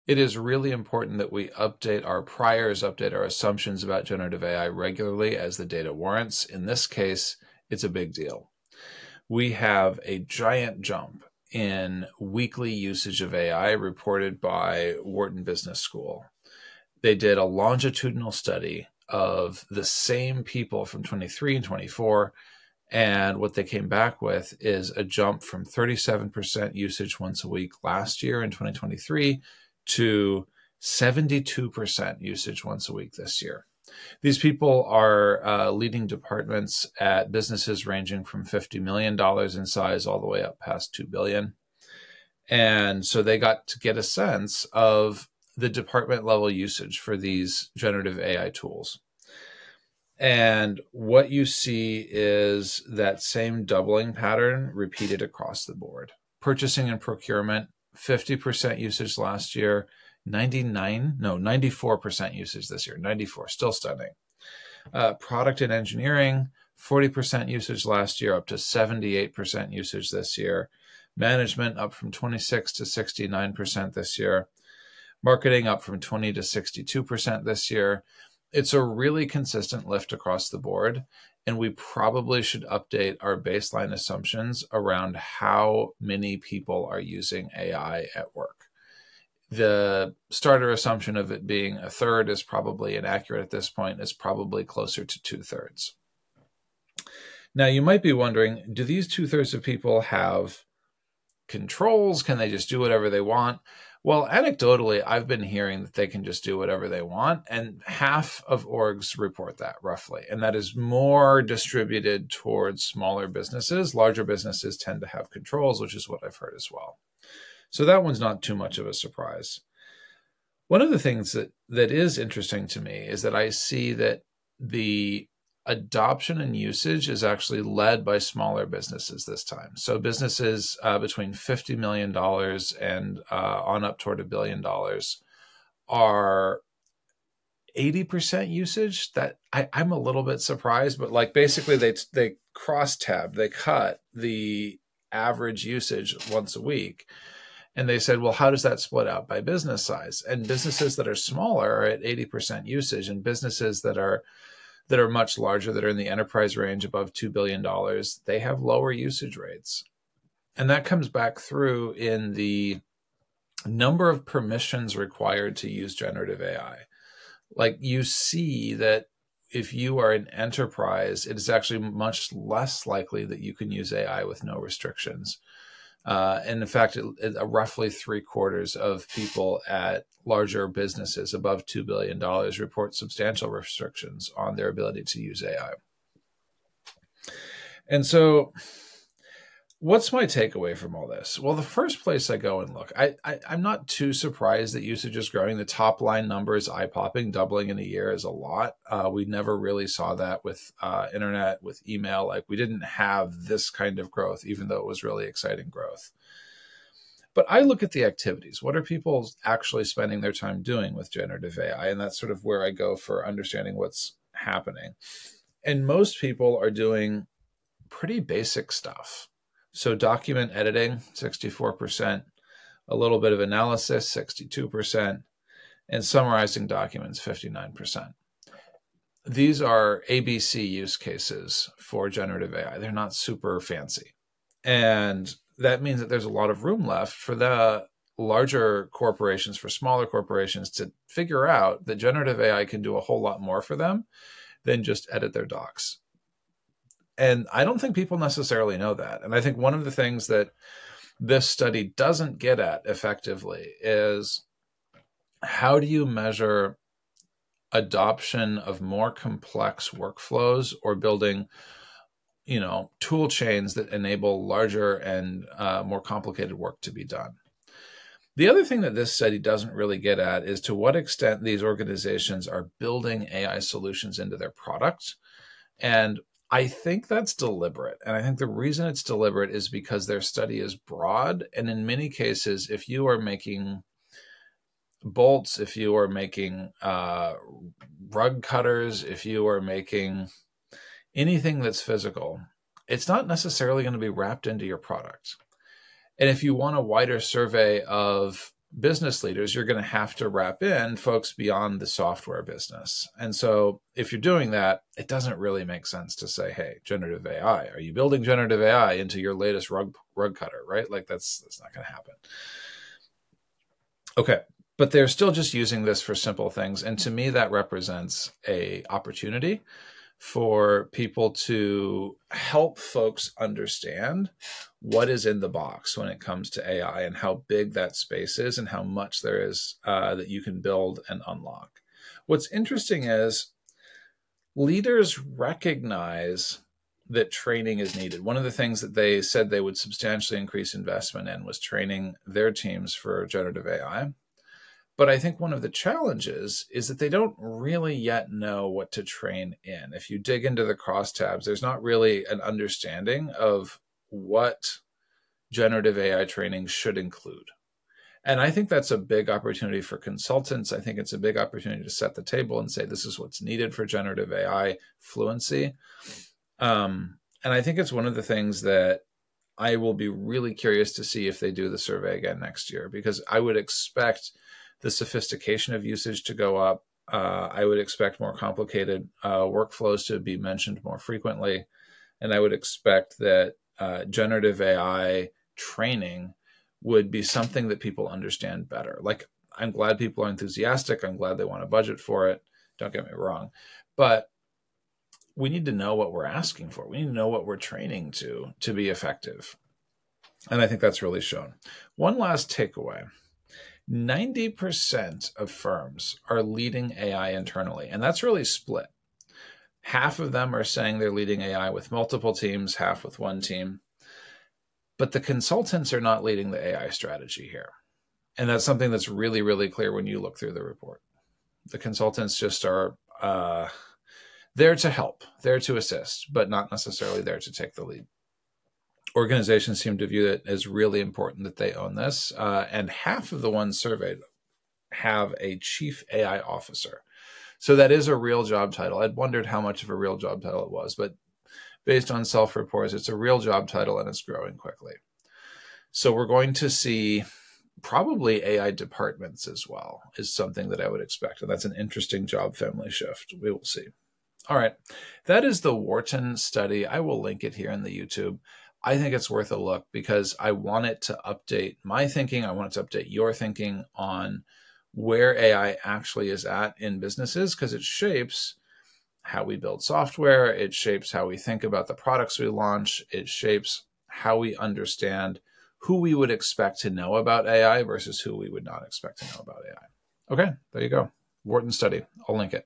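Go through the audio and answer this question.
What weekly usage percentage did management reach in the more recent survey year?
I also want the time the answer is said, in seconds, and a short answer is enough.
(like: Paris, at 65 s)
69%, at 72 s.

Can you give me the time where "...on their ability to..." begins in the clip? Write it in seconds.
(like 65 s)
184 s.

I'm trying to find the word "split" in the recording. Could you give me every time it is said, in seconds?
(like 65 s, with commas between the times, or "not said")
148 s, 408 s.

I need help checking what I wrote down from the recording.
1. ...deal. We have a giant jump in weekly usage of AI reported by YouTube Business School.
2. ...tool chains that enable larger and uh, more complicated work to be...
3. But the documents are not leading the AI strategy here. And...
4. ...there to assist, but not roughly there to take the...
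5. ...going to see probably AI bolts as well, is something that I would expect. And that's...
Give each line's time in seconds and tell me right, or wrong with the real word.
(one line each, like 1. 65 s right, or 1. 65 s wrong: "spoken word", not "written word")
1. 8 s wrong: "Wharton", not "YouTube"
2. 262 s right
3. 414 s wrong: "consultants", not "documents"
4. 425 s wrong: "necessarily", not "roughly"
5. 446 s wrong: "departments", not "bolts".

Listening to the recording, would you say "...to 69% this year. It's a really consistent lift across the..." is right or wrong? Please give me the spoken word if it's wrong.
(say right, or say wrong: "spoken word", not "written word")
wrong: "62", not "69".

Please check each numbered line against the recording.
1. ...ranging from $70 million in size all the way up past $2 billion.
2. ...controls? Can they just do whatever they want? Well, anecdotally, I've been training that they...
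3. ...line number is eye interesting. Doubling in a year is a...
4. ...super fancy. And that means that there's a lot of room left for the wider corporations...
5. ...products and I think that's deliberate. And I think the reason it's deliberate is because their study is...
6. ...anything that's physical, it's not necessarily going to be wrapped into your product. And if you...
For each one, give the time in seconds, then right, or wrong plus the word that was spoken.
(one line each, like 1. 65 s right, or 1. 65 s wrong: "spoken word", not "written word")
1. 37 s wrong: "50", not "70"
2. 101 s wrong: "hearing", not "training"
3. 196 s wrong: "popping", not "interesting"
4. 233 s wrong: "larger", not "wider"
5. 274 s right
6. 291 s right.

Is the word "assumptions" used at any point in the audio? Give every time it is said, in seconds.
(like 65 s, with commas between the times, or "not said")
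3 s, 83 s, 90 s.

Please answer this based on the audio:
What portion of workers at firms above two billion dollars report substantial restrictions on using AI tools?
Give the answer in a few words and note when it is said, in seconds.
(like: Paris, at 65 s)
three quarters, at 177 s.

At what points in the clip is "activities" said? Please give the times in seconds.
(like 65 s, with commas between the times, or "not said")
208 s.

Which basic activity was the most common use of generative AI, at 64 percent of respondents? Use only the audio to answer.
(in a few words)
document editing.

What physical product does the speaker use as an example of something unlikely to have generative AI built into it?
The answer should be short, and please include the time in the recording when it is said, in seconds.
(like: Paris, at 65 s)
rug cutter, at 310 s.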